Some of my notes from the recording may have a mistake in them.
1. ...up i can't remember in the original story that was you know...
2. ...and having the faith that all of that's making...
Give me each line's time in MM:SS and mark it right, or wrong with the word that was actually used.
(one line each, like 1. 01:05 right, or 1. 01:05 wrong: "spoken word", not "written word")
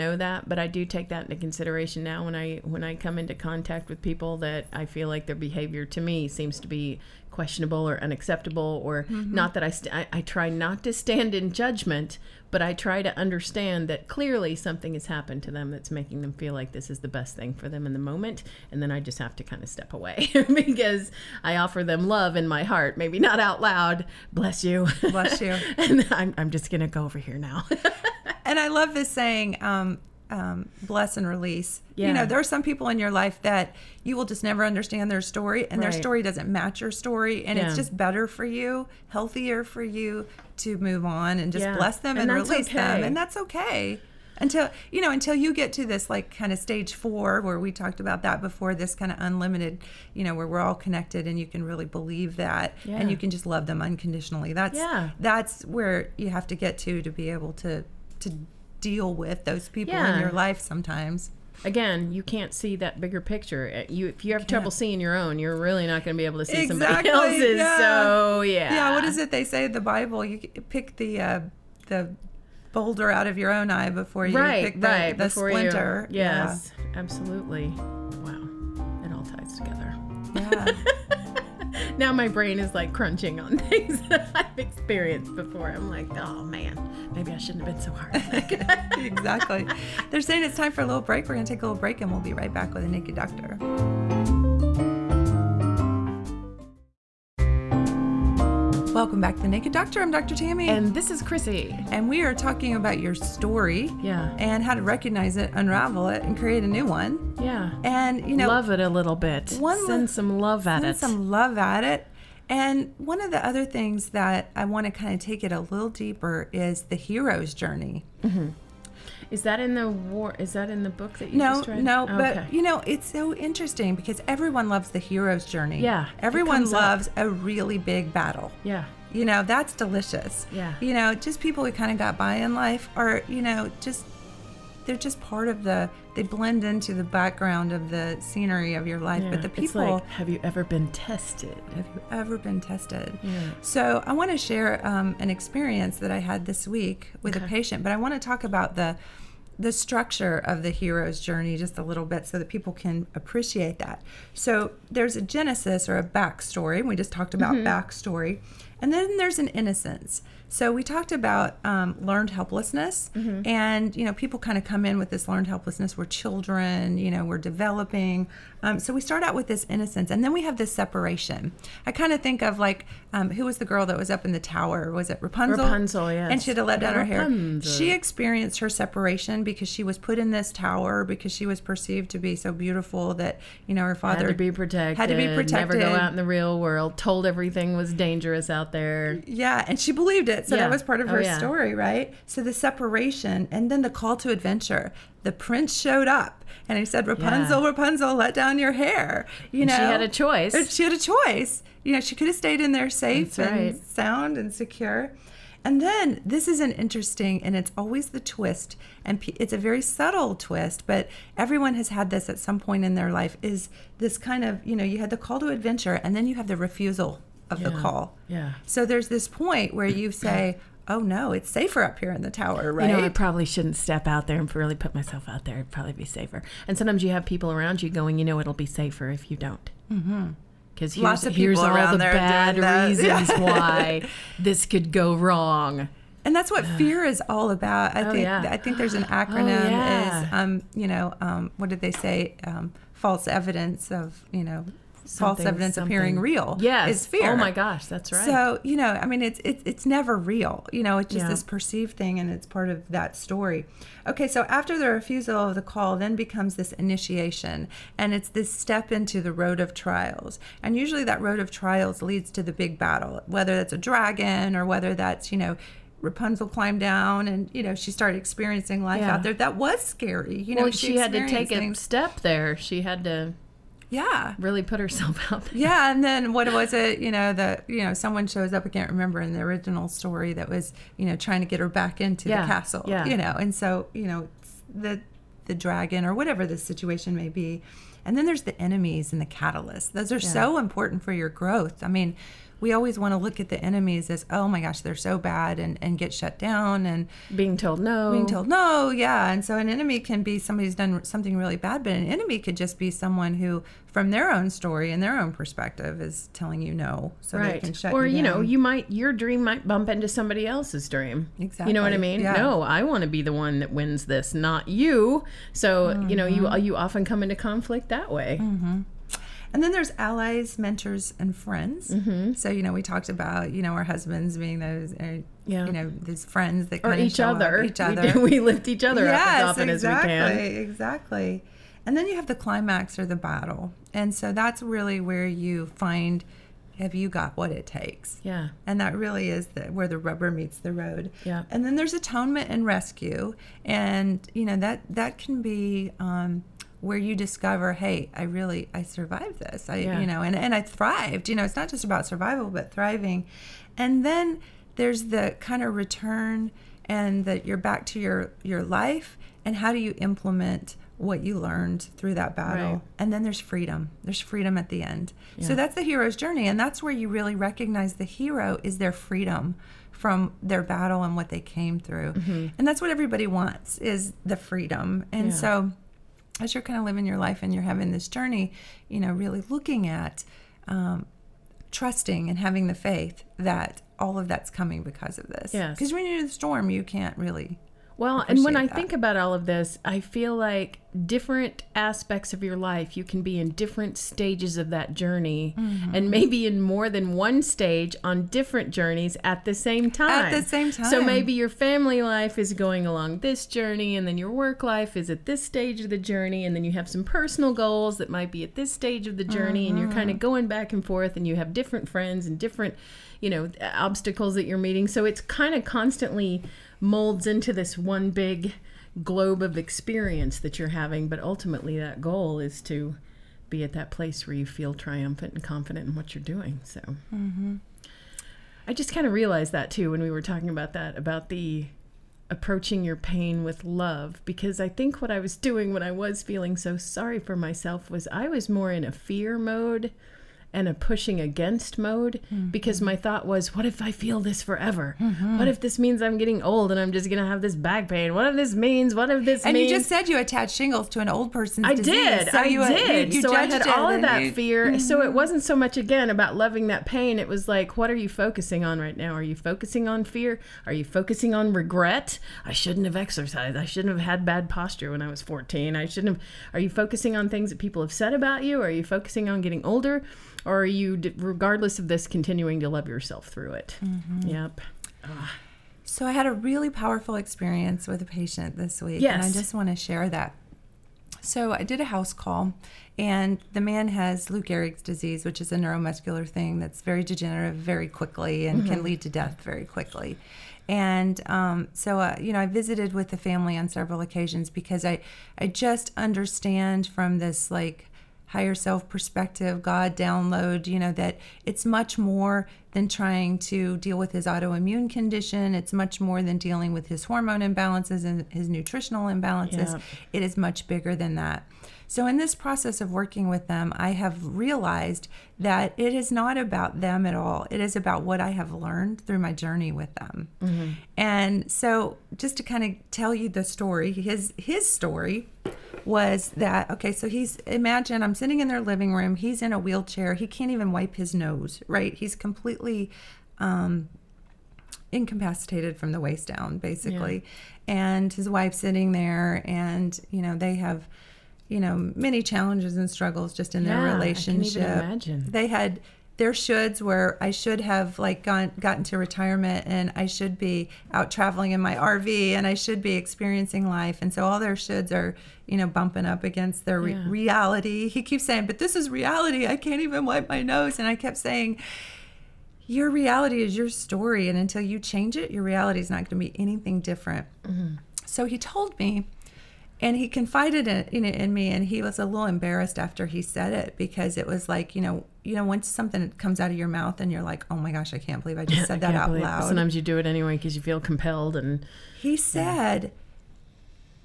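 1. 04:38 right
2. 06:22 wrong: "coming", not "making".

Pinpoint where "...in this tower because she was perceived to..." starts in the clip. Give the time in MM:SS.
03:00.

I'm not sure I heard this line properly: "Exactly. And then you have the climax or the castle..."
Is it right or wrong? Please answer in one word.
wrong.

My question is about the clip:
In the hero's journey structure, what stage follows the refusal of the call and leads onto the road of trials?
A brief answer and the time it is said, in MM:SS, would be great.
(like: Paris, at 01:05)
Initiation, at 04:16.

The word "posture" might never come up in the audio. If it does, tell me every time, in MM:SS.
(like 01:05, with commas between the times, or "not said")
07:44.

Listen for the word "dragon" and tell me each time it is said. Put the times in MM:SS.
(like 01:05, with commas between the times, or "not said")
04:23, 04:45.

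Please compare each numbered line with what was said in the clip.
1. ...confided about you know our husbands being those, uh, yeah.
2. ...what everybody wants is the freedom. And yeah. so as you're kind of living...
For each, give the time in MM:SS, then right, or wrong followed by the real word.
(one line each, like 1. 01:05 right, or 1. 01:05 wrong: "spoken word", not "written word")
1. 05:22 wrong: "talked", not "confided"
2. 06:12 right.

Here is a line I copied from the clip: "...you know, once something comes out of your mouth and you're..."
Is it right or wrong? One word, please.
right.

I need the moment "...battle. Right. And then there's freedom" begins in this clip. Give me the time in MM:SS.
06:02.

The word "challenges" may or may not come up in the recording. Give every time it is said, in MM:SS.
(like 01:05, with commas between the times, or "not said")
09:02.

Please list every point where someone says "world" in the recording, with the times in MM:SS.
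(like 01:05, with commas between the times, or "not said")
03:06.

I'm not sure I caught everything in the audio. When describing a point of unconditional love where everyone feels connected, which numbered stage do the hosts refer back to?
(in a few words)
Stage four.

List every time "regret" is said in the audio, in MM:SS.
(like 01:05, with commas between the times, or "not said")
07:41.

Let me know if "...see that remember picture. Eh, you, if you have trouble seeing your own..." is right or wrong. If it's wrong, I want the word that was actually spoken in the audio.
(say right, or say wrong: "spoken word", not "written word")
wrong: "bigger", not "remember".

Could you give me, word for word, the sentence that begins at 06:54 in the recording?
So it's kind of constantly molds into this one big globe of experience that you're having.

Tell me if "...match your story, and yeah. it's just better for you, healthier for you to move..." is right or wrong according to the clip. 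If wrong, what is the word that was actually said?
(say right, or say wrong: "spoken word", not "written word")
right.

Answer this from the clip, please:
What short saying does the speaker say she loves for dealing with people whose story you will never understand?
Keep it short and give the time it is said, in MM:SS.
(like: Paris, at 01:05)
Bless and release, at 00:30.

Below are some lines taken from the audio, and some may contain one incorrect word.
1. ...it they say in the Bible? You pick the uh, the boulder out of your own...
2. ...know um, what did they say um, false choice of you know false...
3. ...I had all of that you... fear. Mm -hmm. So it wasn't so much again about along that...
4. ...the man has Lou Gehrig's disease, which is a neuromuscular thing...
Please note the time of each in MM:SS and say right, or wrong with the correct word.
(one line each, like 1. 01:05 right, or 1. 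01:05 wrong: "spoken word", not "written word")
1. 01:09 right
2. 04:00 wrong: "evidence", not "choice"
3. 07:33 wrong: "loving", not "along"
4. 08:03 right.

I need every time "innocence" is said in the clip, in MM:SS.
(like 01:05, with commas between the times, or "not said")
02:39, 02:49.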